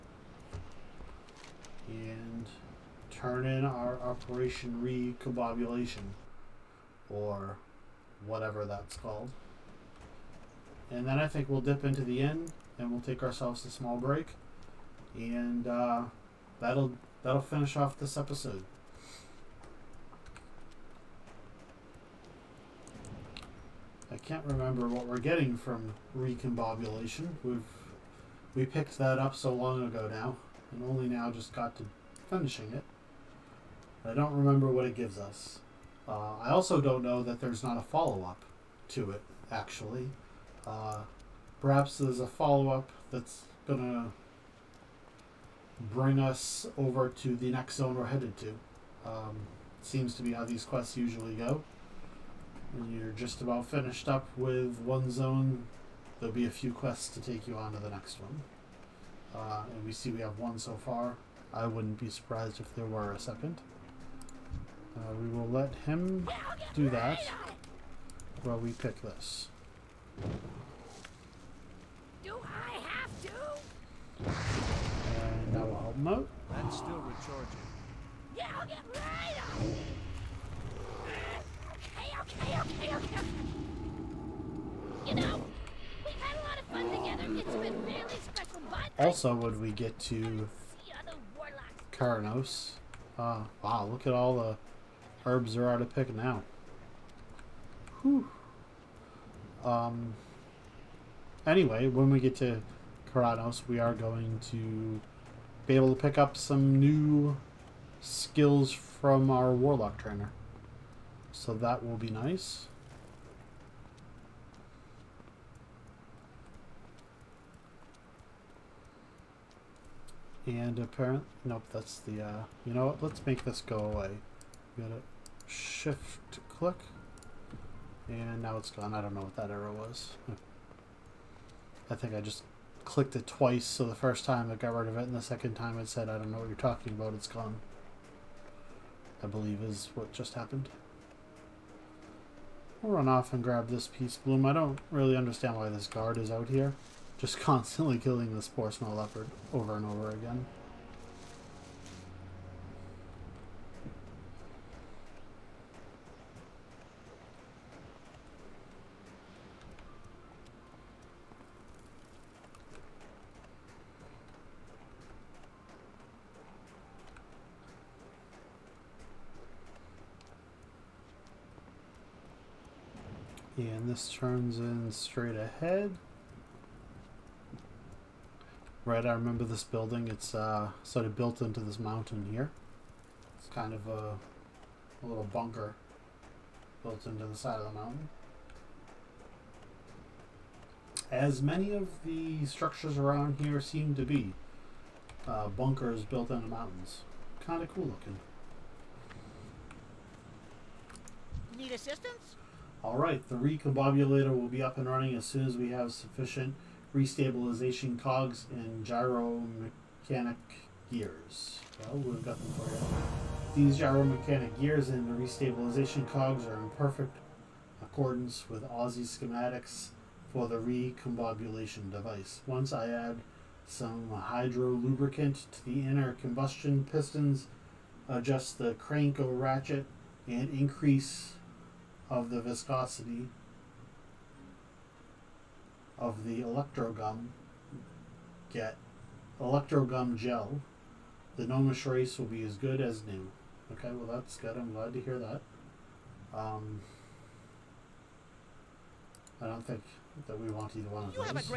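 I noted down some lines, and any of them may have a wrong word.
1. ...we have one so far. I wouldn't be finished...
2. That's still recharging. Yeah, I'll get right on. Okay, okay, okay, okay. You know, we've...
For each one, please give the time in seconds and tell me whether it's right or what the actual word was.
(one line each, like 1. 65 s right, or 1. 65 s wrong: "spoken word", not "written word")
1. 60 s wrong: "surprised", not "finished"
2. 76 s right.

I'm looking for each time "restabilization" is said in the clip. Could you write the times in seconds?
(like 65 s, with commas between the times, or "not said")
206 s, 215 s.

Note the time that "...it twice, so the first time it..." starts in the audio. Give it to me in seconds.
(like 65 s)
133 s.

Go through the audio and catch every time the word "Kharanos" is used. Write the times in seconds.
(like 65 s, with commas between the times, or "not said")
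91 s, 103 s.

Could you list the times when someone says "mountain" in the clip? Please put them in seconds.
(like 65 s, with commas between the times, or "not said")
181 s, 187 s, 196 s.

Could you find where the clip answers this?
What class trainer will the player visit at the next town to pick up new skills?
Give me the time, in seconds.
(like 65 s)
109 s.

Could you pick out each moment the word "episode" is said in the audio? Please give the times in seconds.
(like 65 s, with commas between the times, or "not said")
18 s.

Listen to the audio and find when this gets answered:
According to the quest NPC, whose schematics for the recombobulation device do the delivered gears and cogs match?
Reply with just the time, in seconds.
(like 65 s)
218 s.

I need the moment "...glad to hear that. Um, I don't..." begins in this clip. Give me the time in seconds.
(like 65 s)
244 s.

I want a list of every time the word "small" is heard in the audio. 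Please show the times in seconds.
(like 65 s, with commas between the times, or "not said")
13 s, 148 s.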